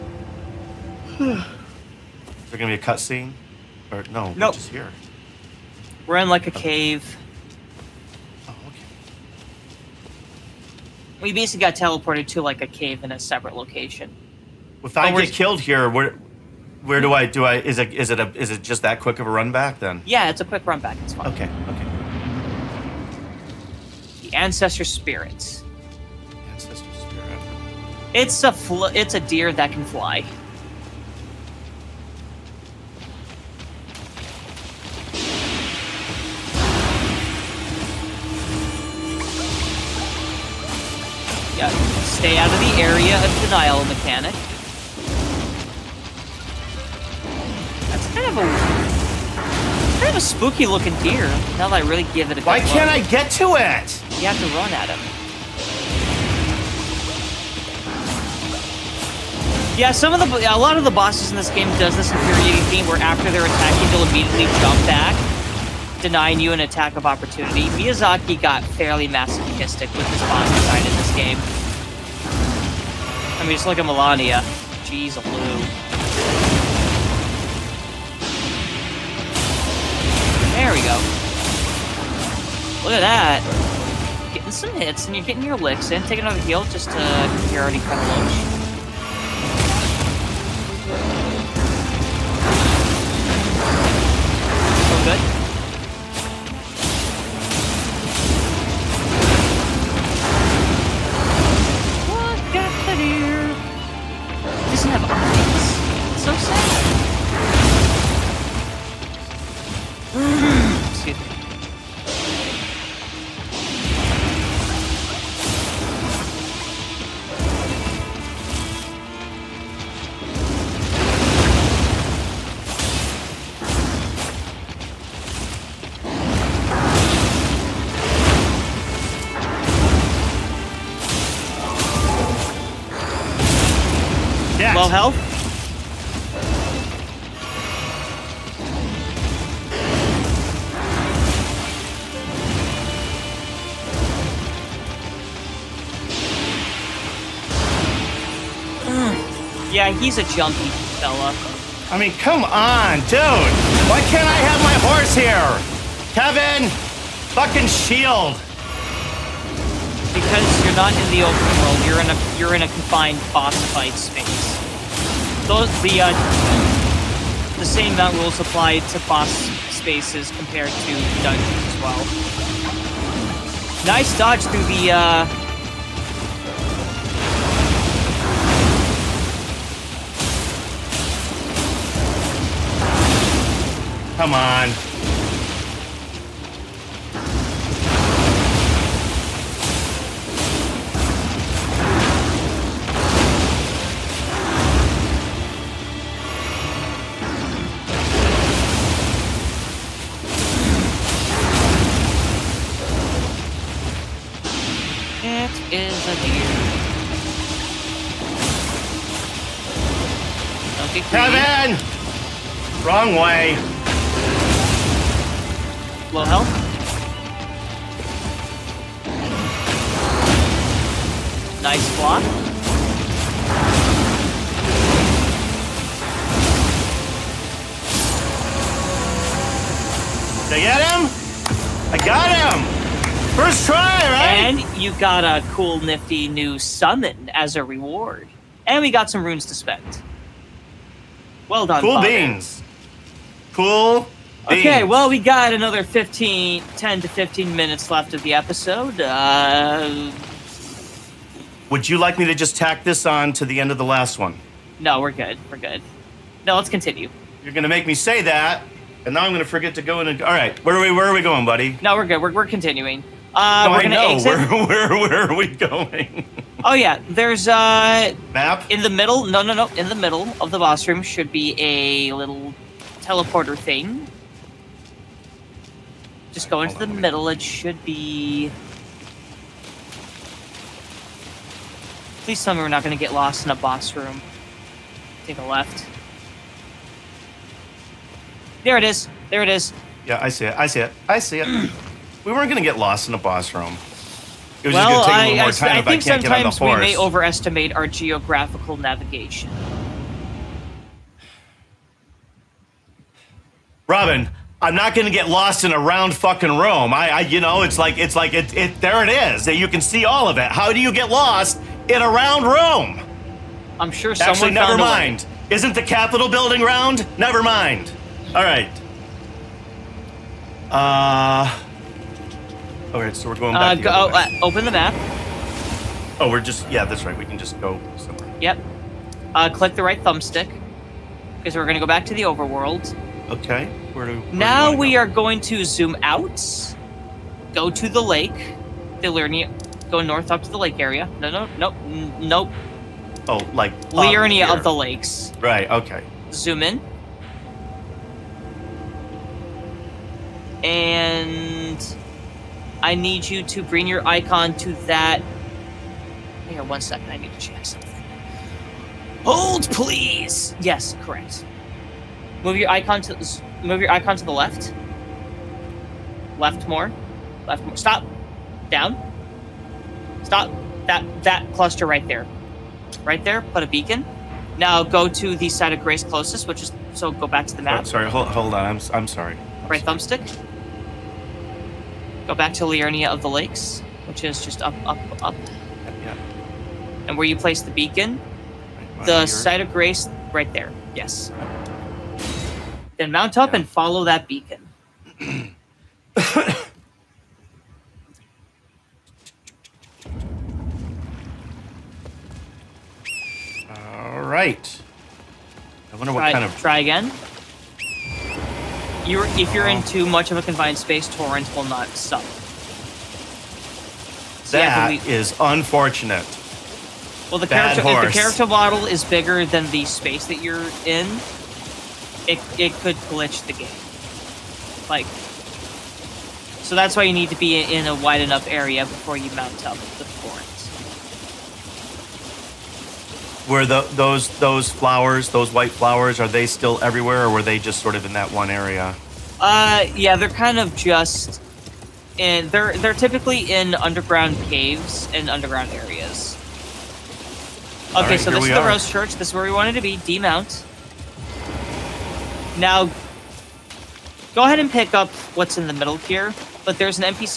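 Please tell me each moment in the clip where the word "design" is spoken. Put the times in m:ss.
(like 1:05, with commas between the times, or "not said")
1:10.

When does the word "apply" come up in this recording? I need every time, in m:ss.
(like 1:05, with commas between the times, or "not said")
2:48.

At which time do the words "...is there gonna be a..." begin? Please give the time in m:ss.
0:01.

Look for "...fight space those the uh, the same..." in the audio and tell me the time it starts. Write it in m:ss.
2:43.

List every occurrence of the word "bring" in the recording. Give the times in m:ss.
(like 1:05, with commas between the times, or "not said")
5:53.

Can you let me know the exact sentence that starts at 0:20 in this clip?
Yeah, it's a quick run back.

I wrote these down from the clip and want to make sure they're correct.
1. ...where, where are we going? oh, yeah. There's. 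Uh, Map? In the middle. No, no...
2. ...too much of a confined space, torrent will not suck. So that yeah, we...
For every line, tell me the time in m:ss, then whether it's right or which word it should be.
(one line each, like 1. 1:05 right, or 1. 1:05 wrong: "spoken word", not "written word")
1. 4:24 right
2. 6:49 right.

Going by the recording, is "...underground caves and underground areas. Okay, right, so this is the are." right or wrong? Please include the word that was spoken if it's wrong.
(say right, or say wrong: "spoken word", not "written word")
right.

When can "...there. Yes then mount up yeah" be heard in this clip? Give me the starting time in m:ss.
6:30.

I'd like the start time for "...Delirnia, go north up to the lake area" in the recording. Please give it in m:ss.
5:39.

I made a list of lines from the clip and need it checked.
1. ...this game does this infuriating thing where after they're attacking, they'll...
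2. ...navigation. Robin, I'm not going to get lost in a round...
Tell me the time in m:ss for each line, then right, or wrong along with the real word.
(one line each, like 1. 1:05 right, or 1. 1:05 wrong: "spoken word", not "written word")
1. 1:01 right
2. 4:58 right.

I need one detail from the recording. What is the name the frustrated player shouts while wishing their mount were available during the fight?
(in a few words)
Kevin.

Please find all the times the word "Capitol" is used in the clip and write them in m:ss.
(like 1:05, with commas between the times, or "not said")
5:15.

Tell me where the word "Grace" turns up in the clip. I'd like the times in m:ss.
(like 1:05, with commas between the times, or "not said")
6:15, 6:29.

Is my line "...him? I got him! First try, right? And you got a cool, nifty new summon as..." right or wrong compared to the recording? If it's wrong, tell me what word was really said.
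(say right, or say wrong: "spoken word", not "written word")
right.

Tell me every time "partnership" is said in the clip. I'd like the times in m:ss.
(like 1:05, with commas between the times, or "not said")
not said.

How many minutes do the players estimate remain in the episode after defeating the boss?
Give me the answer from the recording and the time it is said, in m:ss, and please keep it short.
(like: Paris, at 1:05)
10 to 15, at 4:06.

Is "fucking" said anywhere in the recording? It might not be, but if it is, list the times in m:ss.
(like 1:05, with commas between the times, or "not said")
2:37, 5:06.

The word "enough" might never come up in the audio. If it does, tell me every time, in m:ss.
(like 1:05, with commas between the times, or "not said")
7:08.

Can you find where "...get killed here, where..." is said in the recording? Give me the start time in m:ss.
0:15.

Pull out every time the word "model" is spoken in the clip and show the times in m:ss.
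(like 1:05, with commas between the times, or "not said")
6:58.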